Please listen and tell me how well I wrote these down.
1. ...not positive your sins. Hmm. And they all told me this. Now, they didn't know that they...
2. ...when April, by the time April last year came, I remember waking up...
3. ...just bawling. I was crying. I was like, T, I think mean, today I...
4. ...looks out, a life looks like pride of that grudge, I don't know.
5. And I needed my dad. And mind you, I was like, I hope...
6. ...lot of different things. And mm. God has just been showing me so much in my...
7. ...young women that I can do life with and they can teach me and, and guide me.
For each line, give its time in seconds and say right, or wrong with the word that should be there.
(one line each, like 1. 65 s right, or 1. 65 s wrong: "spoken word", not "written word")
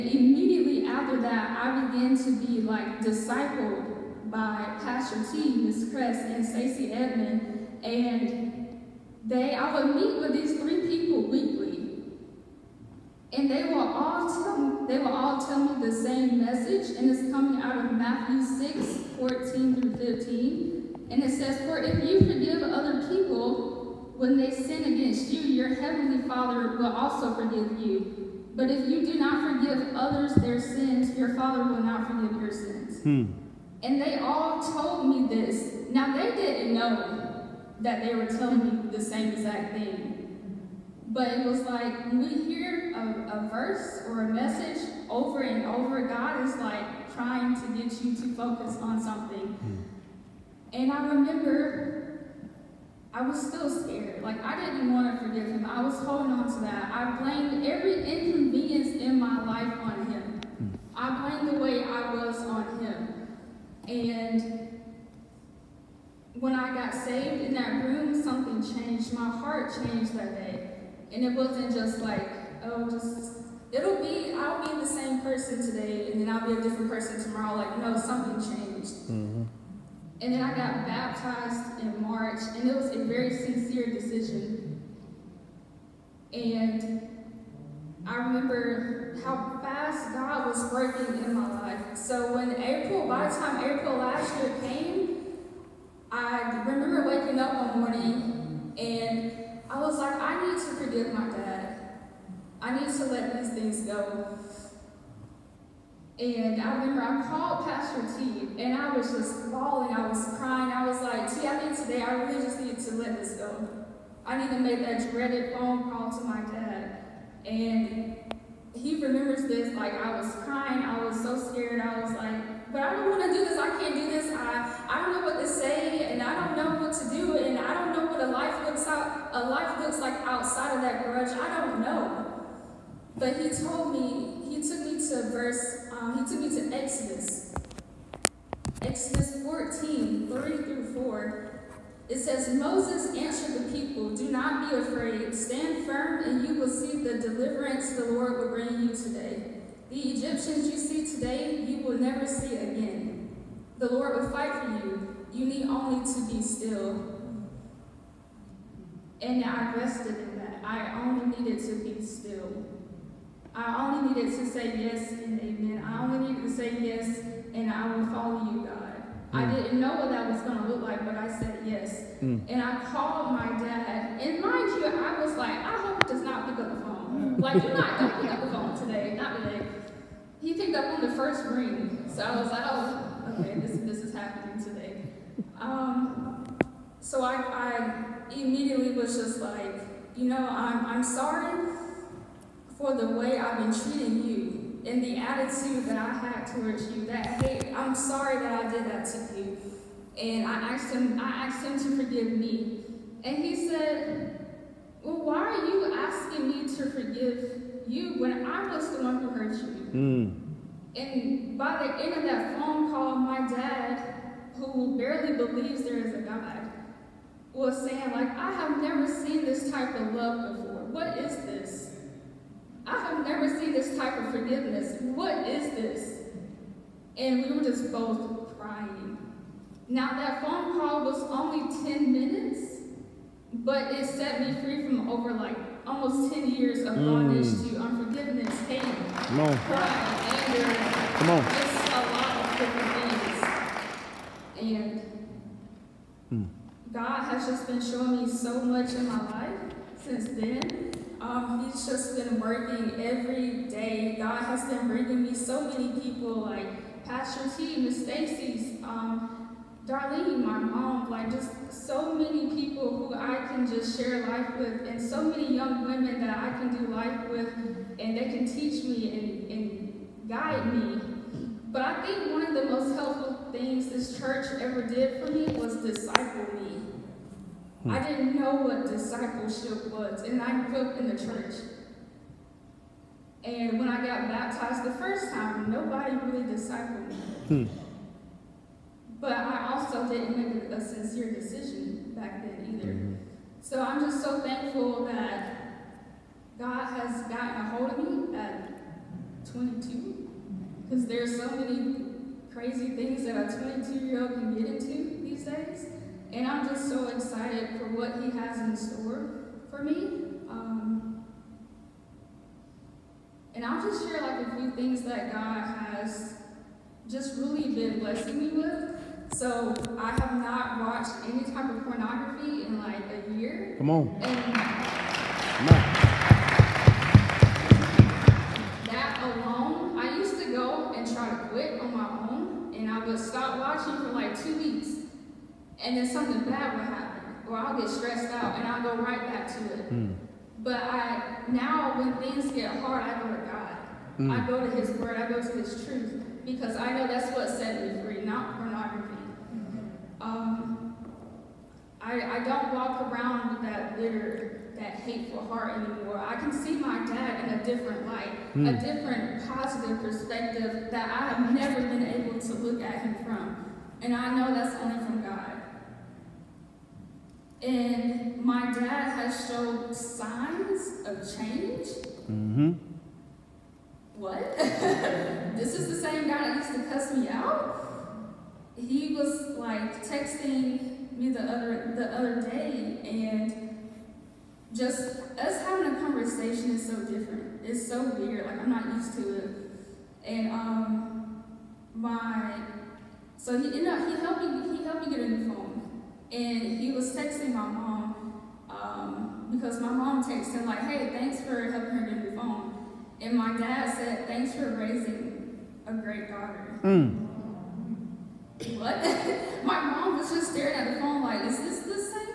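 1. 31 s wrong: "forgive", not "positive"
2. 92 s right
3. 109 s right
4. 128 s wrong: "outside", not "pride"
5. 172 s wrong: "called", not "needed"
6. 242 s right
7. 265 s right.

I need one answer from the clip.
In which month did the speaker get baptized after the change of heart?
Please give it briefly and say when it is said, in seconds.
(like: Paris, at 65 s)
March, at 81 s.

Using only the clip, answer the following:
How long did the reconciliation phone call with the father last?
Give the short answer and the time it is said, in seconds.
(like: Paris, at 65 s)
10 minutes, at 231 s.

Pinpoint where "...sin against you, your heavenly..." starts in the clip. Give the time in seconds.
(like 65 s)
24 s.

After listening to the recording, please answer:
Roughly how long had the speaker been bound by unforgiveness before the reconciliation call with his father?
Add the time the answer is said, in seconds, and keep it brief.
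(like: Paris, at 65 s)
almost 10 years, at 235 s.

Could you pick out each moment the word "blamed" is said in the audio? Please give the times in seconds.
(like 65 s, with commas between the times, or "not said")
57 s, 61 s.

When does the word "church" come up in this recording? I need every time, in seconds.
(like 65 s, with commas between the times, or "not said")
274 s, 281 s.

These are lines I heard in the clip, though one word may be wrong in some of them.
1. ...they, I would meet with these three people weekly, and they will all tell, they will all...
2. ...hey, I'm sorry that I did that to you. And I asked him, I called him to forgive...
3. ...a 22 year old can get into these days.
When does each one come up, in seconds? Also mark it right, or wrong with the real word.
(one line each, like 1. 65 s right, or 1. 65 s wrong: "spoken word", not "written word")
1. 9 s right
2. 197 s wrong: "asked", not "called"
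3. 303 s right.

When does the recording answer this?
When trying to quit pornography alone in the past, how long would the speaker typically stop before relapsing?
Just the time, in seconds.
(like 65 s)
334 s.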